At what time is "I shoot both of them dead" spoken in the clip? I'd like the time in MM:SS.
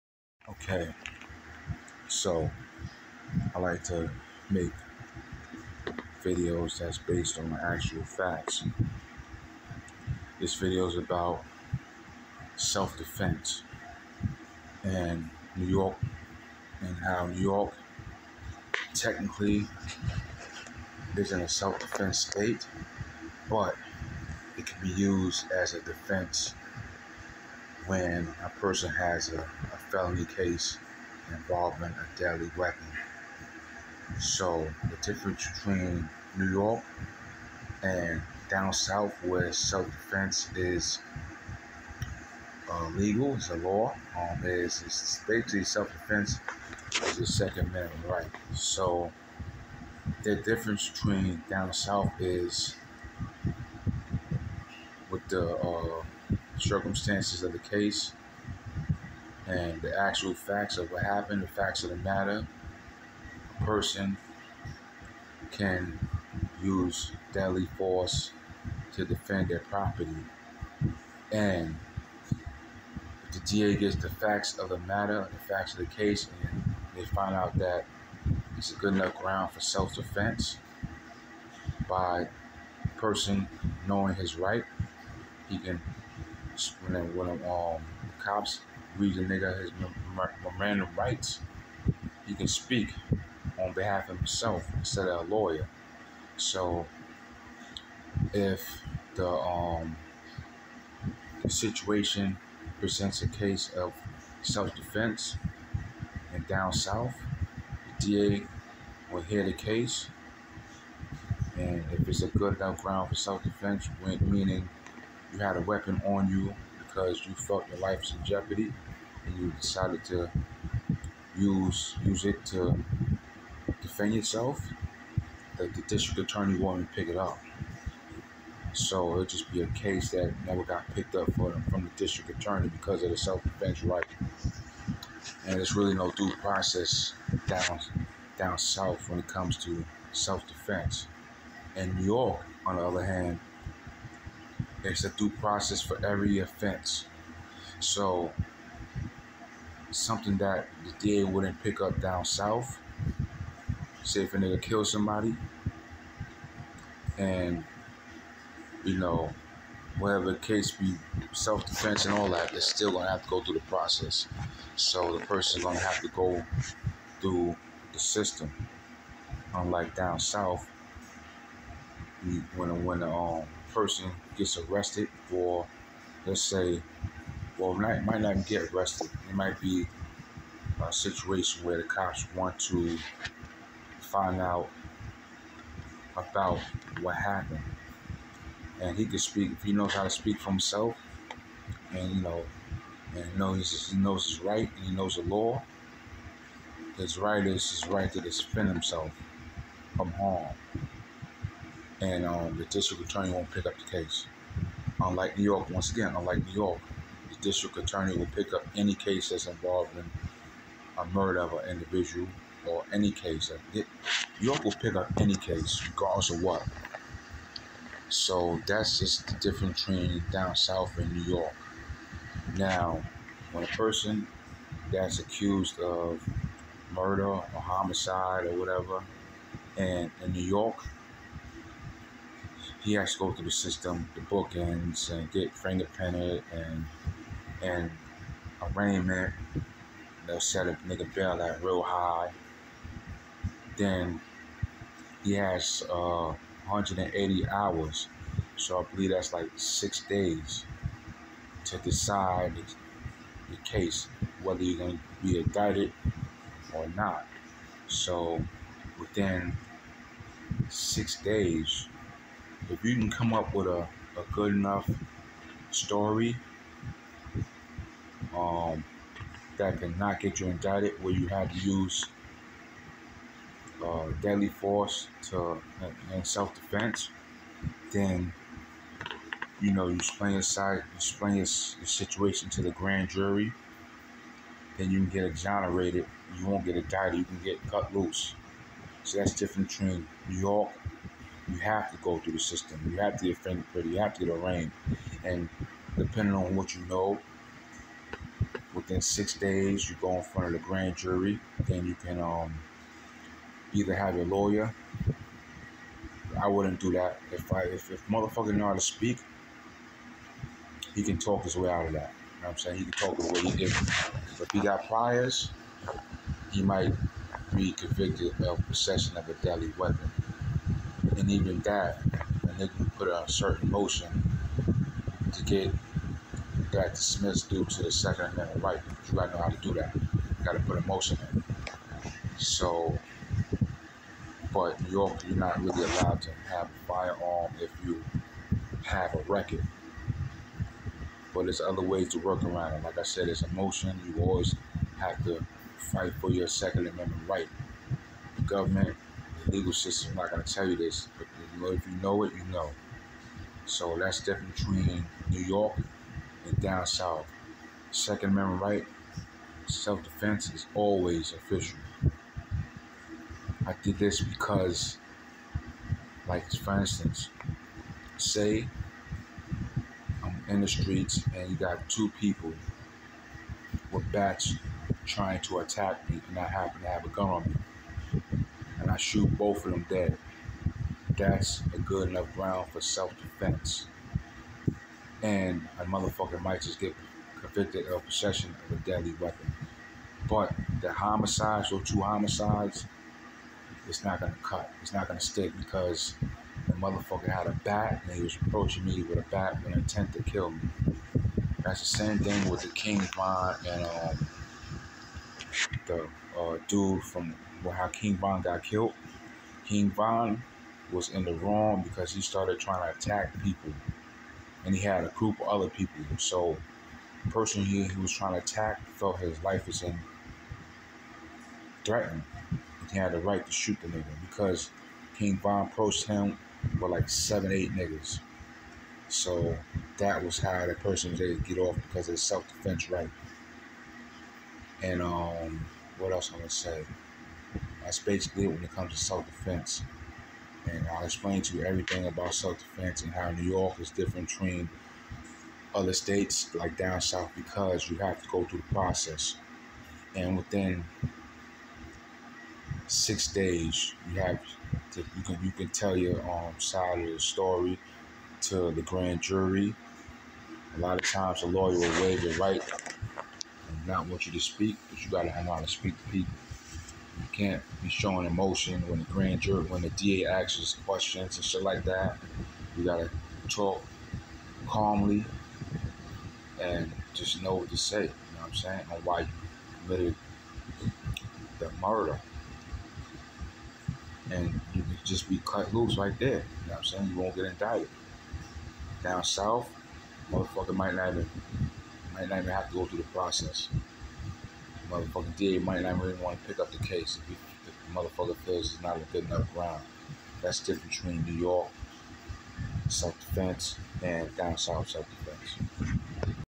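06:18.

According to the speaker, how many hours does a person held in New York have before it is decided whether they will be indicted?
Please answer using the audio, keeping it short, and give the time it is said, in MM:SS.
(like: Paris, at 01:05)
180 hours, at 04:06.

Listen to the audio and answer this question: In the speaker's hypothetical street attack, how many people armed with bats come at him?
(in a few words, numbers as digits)
2.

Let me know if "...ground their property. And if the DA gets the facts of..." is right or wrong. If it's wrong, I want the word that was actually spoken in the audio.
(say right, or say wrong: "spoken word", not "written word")
wrong: "defend", not "ground".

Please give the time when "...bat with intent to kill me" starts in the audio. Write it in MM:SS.
06:39.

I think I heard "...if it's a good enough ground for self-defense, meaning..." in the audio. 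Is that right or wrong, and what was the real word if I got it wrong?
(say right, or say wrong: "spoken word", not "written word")
right.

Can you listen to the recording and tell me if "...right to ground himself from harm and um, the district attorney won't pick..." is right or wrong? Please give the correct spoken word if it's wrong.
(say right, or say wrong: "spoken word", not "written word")
wrong: "defend", not "ground".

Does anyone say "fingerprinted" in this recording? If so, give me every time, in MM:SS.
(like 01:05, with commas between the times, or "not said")
03:55, 04:53.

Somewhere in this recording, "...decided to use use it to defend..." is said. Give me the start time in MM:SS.
01:59.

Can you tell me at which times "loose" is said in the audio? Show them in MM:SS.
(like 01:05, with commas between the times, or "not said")
04:47, 08:05.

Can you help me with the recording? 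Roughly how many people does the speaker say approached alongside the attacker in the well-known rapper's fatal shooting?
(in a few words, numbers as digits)
7 or 8.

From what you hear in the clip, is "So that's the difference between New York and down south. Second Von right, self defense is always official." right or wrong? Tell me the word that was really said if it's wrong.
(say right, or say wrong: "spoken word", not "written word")
wrong: "Amendment", not "Von".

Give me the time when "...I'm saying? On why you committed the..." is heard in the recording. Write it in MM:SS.
07:58.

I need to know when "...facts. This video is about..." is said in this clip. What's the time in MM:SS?
00:08.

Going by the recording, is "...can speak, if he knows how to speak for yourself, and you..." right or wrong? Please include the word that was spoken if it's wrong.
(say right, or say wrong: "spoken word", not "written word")
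wrong: "himself", not "yourself".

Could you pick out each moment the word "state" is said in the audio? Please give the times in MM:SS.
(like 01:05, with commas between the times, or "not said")
00:22, 07:25.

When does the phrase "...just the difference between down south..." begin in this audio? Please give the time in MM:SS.
03:38.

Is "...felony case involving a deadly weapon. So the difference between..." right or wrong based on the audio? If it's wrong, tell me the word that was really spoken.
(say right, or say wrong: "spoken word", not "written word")
right.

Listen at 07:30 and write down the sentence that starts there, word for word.
And within six days, you have to, you can you can tell your um, side of the story to the grand jury.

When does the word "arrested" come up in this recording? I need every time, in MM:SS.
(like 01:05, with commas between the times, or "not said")
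02:54, 02:58.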